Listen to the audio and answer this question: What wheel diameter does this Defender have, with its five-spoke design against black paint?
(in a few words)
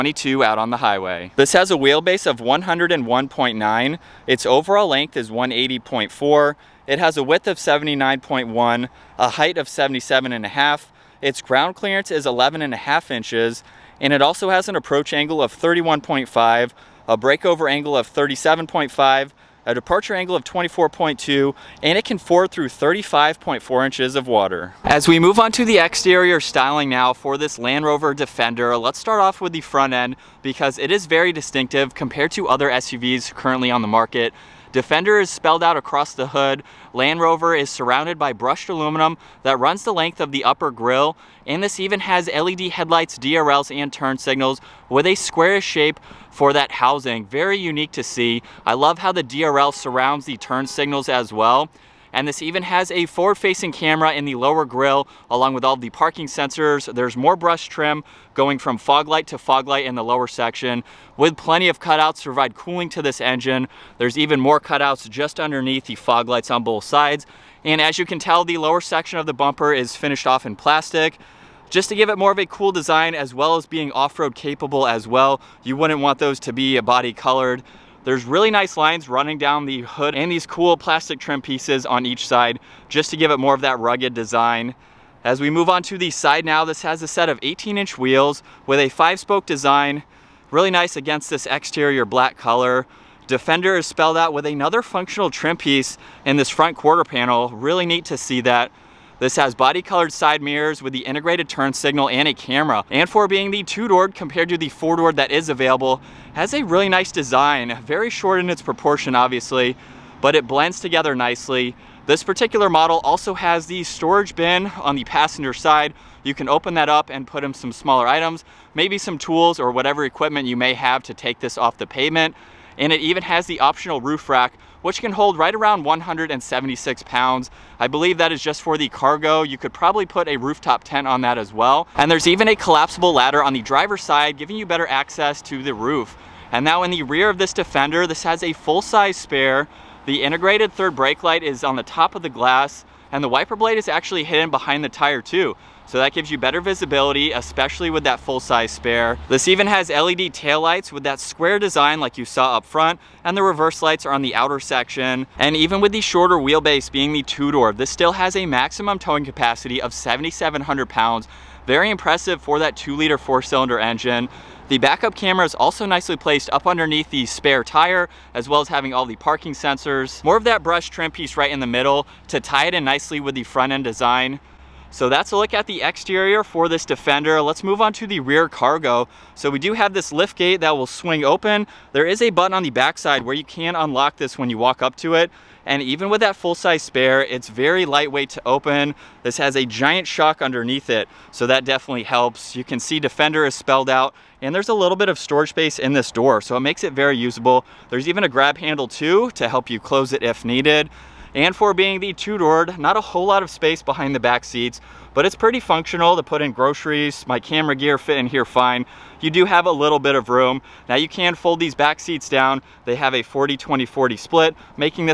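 18 inch.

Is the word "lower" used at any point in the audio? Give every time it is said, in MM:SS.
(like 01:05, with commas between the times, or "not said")
00:54, 01:00, 01:08.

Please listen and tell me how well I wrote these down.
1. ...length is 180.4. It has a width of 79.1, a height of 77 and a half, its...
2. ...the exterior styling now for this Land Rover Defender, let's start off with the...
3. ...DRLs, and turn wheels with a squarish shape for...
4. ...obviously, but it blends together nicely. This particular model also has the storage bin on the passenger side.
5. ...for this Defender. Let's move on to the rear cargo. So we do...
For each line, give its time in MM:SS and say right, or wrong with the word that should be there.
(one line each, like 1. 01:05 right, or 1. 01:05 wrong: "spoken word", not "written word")
1. 00:04 right
2. 00:25 right
3. 00:43 wrong: "signals", not "wheels"
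4. 01:49 right
5. 02:56 right.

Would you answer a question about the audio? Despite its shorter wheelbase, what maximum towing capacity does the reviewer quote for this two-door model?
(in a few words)
7,700 pounds.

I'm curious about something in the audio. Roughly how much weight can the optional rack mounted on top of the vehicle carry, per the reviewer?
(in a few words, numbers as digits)
176 pounds.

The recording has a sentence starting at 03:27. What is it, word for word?
My camera gear fit in here fine.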